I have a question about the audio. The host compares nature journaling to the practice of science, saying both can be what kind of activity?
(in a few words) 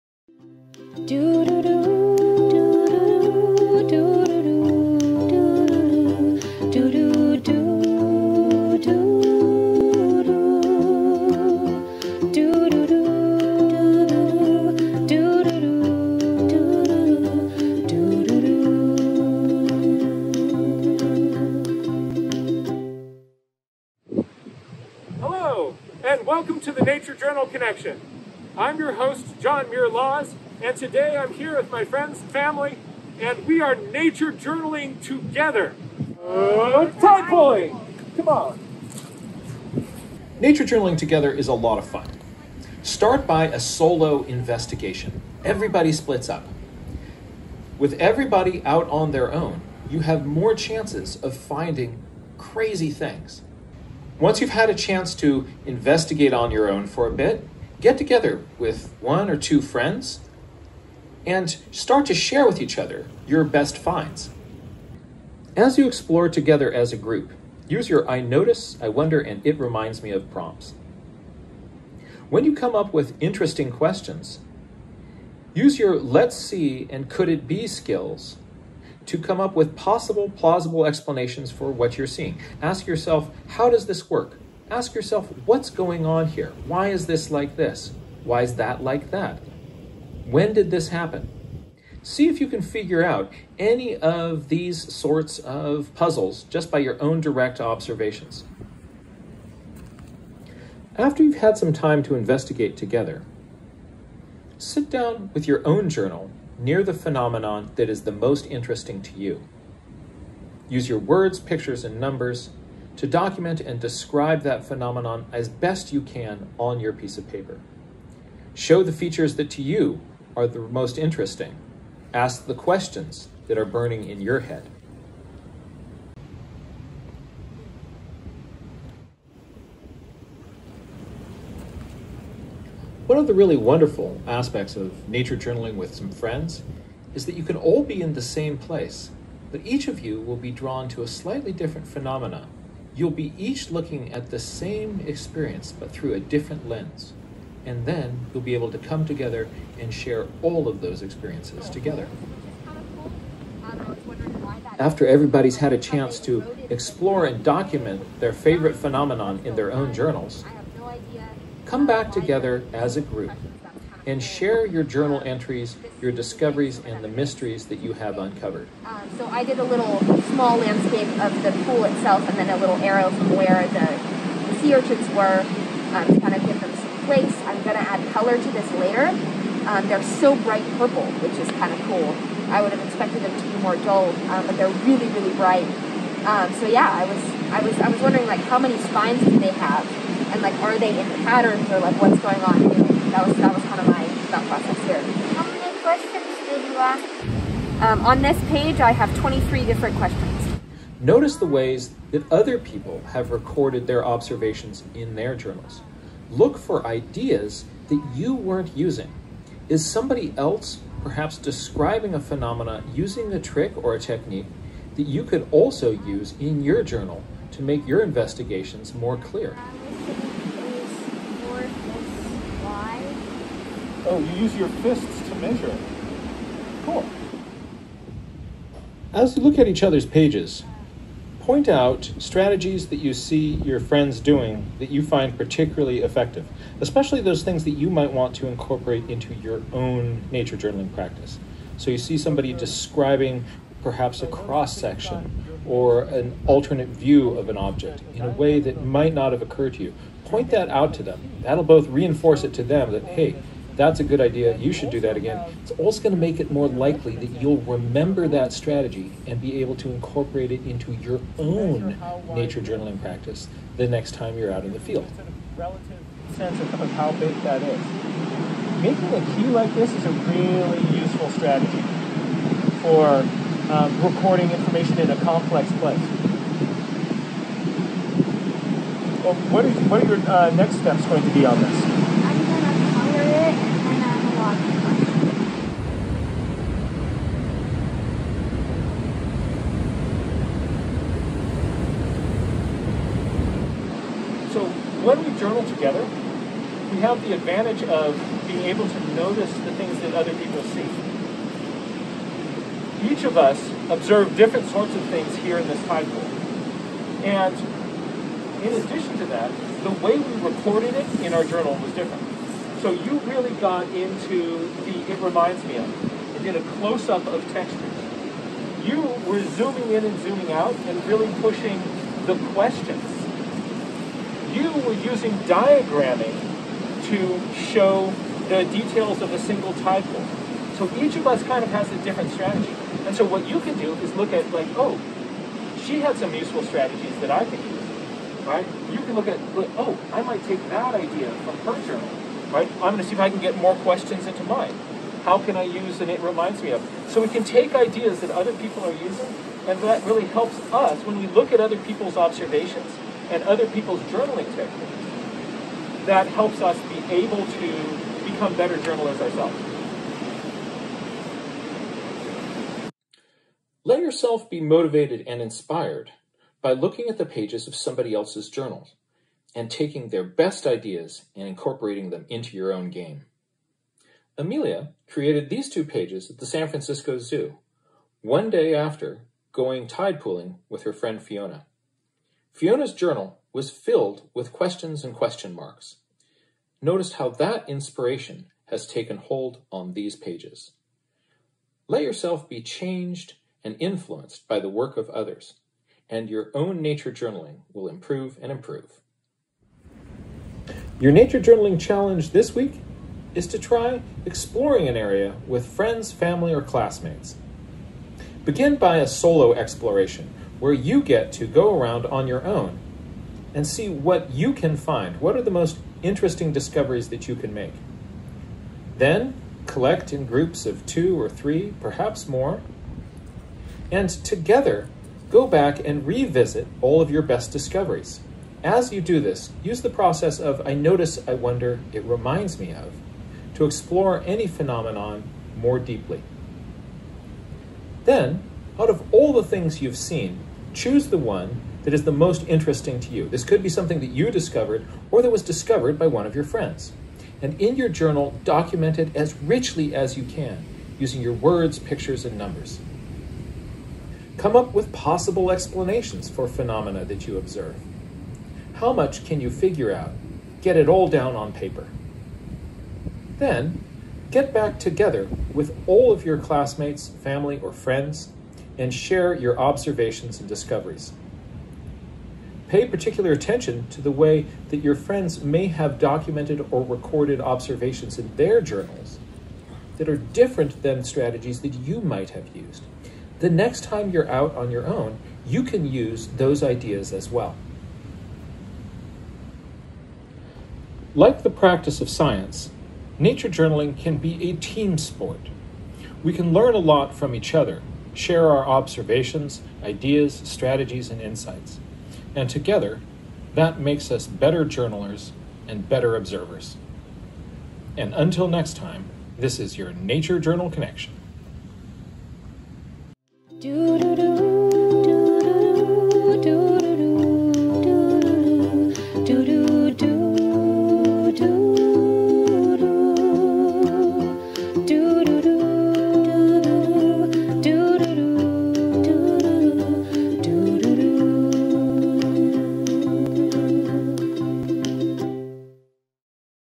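a team sport.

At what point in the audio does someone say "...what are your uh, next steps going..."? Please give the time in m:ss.
4:39.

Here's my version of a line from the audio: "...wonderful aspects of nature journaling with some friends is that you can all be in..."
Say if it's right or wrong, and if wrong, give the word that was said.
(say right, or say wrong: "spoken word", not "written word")
right.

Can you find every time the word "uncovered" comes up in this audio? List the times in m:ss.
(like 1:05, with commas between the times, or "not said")
2:48.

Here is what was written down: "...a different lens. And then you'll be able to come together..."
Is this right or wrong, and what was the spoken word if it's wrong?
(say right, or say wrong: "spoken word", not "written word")
right.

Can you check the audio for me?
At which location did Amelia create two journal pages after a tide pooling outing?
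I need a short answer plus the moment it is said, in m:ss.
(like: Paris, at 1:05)
San Francisco Zoo, at 6:16.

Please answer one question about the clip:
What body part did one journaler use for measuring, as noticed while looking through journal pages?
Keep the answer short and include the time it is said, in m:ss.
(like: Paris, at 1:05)
fists, at 3:44.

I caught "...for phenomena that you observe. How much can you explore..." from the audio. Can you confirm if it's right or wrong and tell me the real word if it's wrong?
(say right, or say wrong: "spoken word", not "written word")
wrong: "figure", not "explore".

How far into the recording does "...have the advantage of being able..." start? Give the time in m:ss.
4:56.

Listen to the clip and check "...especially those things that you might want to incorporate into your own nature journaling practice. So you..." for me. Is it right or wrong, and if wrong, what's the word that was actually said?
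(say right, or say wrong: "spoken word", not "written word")
right.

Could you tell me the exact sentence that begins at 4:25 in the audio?
Relative sense of how big that is.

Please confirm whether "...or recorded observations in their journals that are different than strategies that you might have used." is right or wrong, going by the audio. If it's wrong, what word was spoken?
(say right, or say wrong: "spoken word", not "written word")
right.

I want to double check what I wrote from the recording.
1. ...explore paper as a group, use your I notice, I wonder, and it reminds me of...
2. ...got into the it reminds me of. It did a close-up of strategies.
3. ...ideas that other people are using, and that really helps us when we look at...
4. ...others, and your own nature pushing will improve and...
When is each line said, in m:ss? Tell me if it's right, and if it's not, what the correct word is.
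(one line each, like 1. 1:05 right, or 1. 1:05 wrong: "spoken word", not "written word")
1. 1:05 wrong: "together", not "paper"
2. 5:13 wrong: "textures", not "strategies"
3. 5:47 right
4. 6:35 wrong: "journaling", not "pushing".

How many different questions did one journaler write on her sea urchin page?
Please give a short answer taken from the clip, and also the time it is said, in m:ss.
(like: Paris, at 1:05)
23, at 3:19.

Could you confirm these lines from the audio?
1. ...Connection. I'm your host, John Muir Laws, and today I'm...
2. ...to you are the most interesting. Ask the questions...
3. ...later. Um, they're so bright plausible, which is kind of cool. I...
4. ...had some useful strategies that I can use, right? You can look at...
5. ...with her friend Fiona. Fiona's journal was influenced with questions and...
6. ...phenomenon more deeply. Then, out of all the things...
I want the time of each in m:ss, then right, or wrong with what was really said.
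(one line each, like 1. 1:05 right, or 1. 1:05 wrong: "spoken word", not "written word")
1. 0:27 right
2. 1:59 right
3. 2:58 wrong: "purple", not "plausible"
4. 5:36 right
5. 6:20 wrong: "filled", not "influenced"
6. 7:14 right.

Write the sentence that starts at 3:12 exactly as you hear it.
Anyway, that was that was kind of my thought process here.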